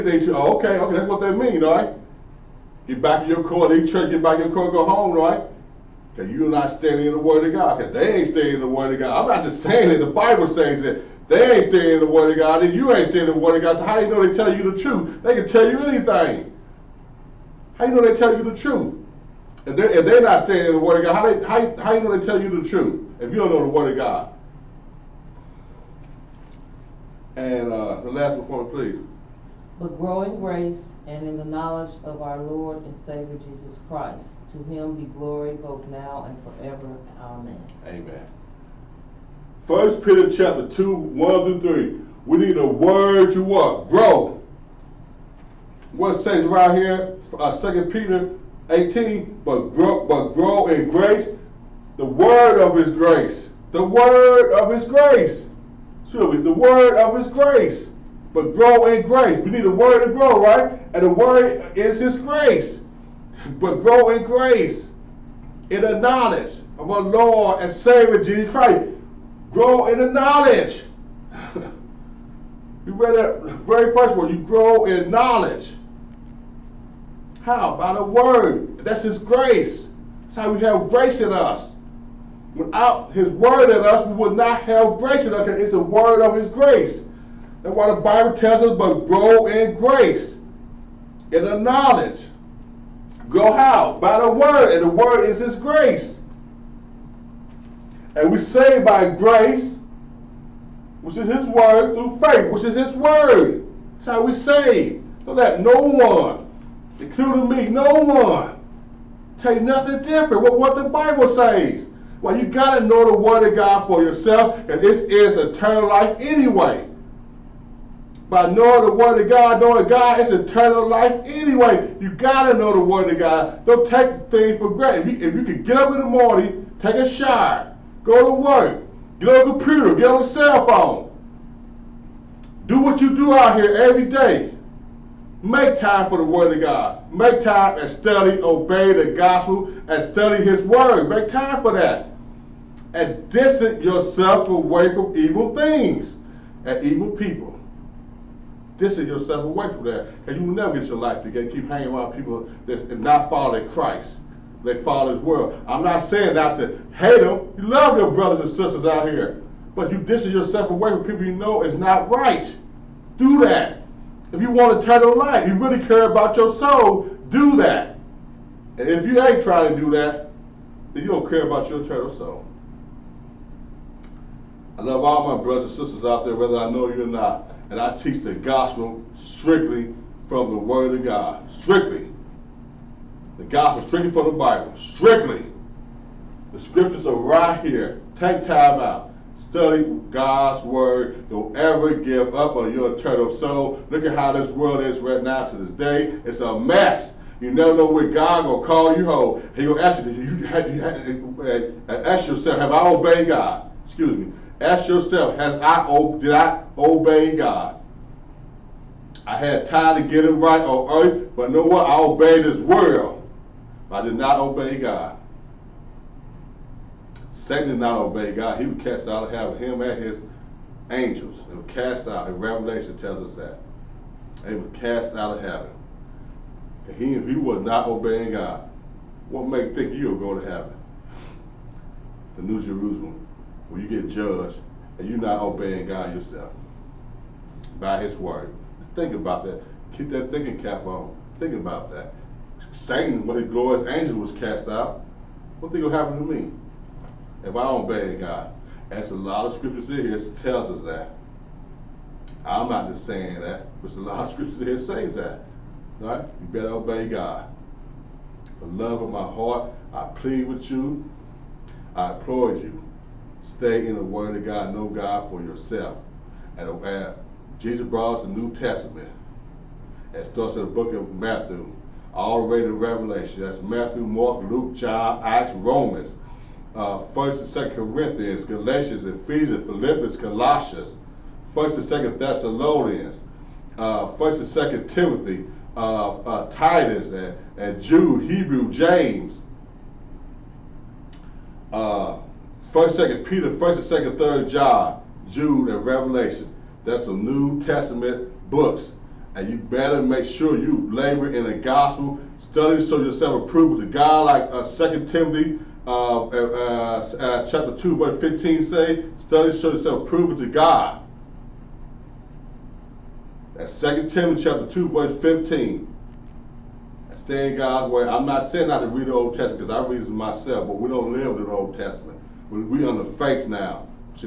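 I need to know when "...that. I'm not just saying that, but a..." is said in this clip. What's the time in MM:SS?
04:10.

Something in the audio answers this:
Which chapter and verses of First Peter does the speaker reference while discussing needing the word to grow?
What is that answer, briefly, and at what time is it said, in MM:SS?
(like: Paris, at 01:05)
Chapter 2, 1 through 3, at 00:39.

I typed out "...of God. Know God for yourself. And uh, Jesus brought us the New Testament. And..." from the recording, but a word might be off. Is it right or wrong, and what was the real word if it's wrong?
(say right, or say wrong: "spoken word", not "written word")
right.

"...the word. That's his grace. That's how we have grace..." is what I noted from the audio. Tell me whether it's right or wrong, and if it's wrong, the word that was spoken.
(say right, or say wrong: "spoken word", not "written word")
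right.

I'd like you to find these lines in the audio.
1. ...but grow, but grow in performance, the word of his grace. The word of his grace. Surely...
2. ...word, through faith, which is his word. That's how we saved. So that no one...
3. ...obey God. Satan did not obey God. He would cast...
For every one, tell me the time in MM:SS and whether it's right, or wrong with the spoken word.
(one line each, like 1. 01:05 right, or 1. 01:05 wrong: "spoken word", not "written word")
1. 00:49 wrong: "grace", not "performance"
2. 01:41 right
3. 03:34 right.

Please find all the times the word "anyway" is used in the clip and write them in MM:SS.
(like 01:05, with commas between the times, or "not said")
01:56, 02:01.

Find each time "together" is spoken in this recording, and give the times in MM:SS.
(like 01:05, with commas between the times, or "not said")
02:31.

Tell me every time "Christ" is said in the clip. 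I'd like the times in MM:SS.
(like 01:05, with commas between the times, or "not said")
00:33, 01:08, 02:33.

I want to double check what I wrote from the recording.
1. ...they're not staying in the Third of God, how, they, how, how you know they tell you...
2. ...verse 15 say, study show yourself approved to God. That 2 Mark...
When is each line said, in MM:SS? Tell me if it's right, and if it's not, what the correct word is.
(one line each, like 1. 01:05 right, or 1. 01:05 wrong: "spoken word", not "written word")
1. 00:20 wrong: "Word", not "Third"
2. 05:07 wrong: "Timothy", not "Mark".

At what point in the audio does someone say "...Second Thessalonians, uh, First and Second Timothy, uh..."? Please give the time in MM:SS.
04:41.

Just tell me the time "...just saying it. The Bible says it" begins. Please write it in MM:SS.
00:09.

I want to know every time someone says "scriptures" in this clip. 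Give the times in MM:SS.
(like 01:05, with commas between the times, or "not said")
03:06, 04:09, 04:14.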